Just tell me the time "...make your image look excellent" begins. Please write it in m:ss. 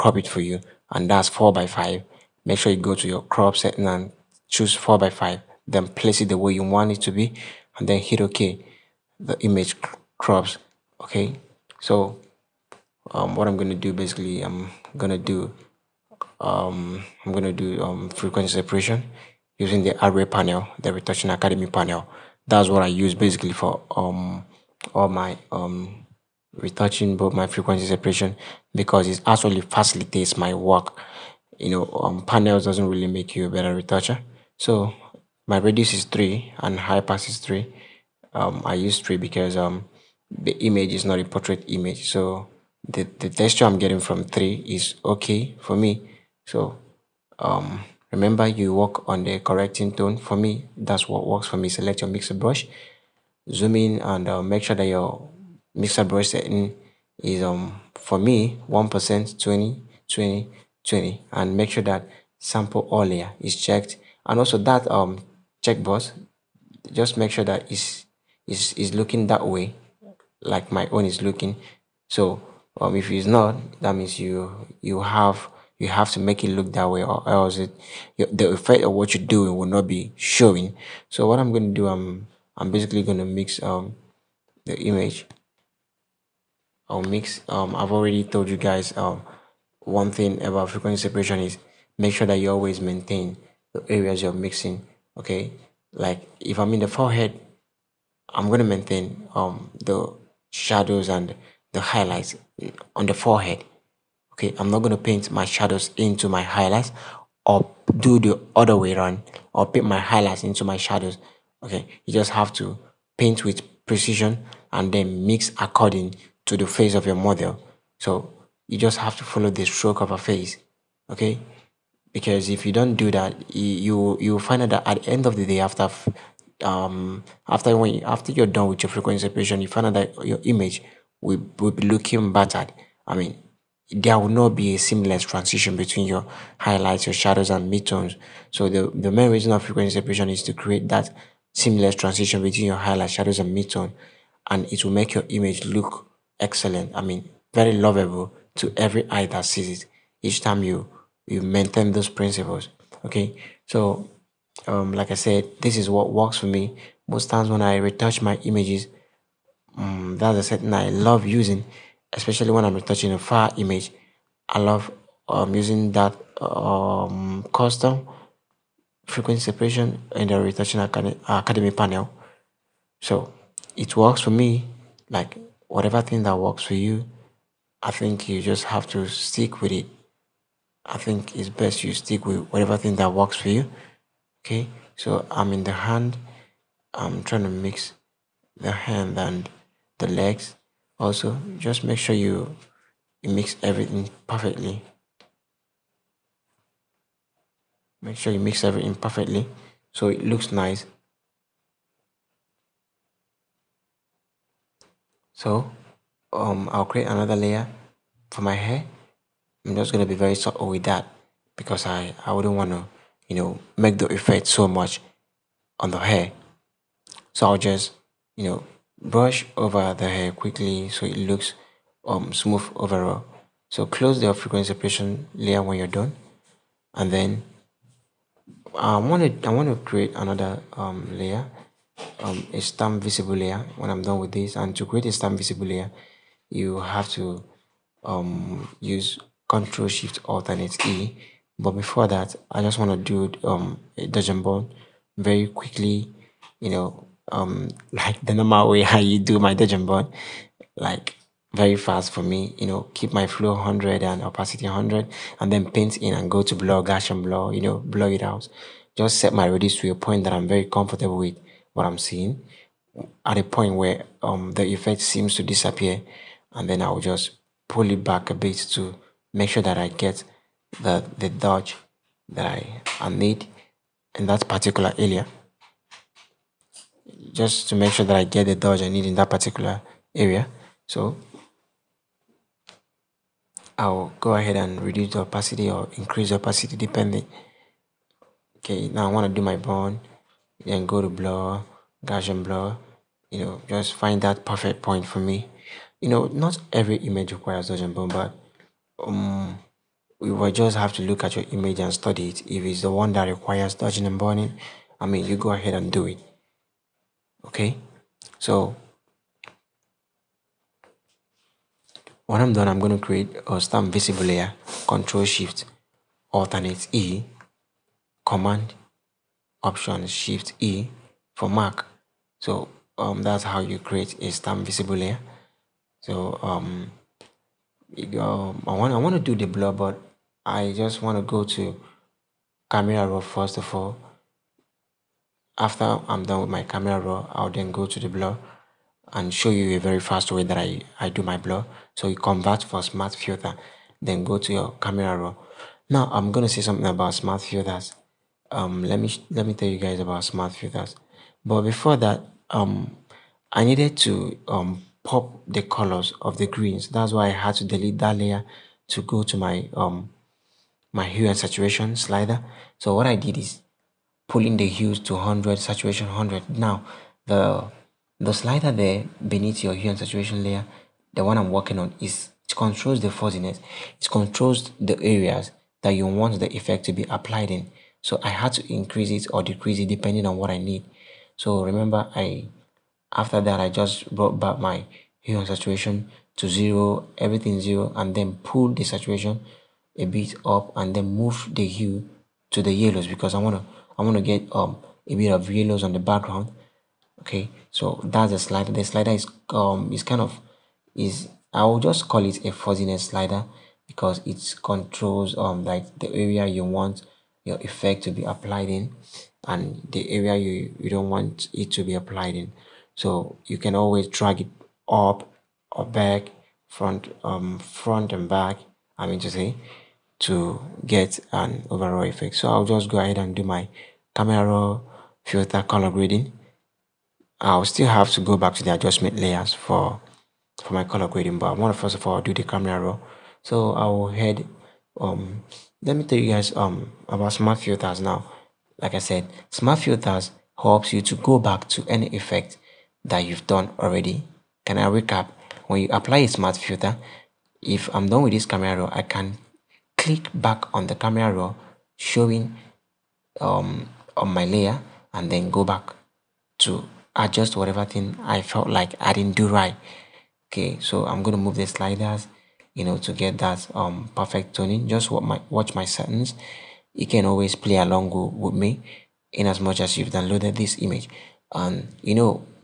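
2:24.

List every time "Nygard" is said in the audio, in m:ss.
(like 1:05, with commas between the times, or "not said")
not said.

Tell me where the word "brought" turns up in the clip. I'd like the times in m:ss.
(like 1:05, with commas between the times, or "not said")
6:24.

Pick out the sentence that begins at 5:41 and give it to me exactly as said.
So you convert for smart filter, then go to your camera raw.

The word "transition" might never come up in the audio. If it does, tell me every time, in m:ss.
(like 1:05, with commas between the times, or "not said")
2:15, 2:21.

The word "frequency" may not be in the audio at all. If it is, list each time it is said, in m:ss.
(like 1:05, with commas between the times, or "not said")
0:18, 0:27, 1:30, 2:08, 2:19, 2:49, 3:44.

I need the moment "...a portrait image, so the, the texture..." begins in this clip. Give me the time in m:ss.
0:41.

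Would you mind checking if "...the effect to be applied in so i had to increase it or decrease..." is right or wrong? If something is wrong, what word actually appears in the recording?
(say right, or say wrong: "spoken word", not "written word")
right.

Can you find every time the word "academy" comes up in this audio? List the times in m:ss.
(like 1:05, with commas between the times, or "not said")
0:21, 2:50.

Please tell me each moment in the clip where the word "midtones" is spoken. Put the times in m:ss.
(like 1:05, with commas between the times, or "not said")
2:17, 2:23.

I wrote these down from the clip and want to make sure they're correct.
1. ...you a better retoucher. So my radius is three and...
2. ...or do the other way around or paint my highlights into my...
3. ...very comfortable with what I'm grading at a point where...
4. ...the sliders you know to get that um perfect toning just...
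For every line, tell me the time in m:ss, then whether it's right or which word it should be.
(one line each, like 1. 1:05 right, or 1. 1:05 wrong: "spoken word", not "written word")
1. 0:33 right
2. 1:47 right
3. 4:20 wrong: "seeing", not "grading"
4. 7:41 right.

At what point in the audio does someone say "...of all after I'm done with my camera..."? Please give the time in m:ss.
5:33.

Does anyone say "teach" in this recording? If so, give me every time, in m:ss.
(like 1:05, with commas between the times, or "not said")
not said.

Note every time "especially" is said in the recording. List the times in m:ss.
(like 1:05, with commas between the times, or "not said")
2:42.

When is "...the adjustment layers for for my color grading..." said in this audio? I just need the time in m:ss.
7:08.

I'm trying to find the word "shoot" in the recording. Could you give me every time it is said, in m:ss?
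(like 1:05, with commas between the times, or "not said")
not said.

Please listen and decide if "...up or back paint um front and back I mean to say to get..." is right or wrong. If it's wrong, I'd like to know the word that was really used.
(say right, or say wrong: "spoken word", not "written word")
wrong: "front", not "paint".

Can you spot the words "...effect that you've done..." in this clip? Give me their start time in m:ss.
7:22.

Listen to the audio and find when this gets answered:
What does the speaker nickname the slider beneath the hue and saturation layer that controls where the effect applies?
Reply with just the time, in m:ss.
6:42.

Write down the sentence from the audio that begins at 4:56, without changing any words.
You know, not every image requires and bond, but um, we will just have to look at your image and study it.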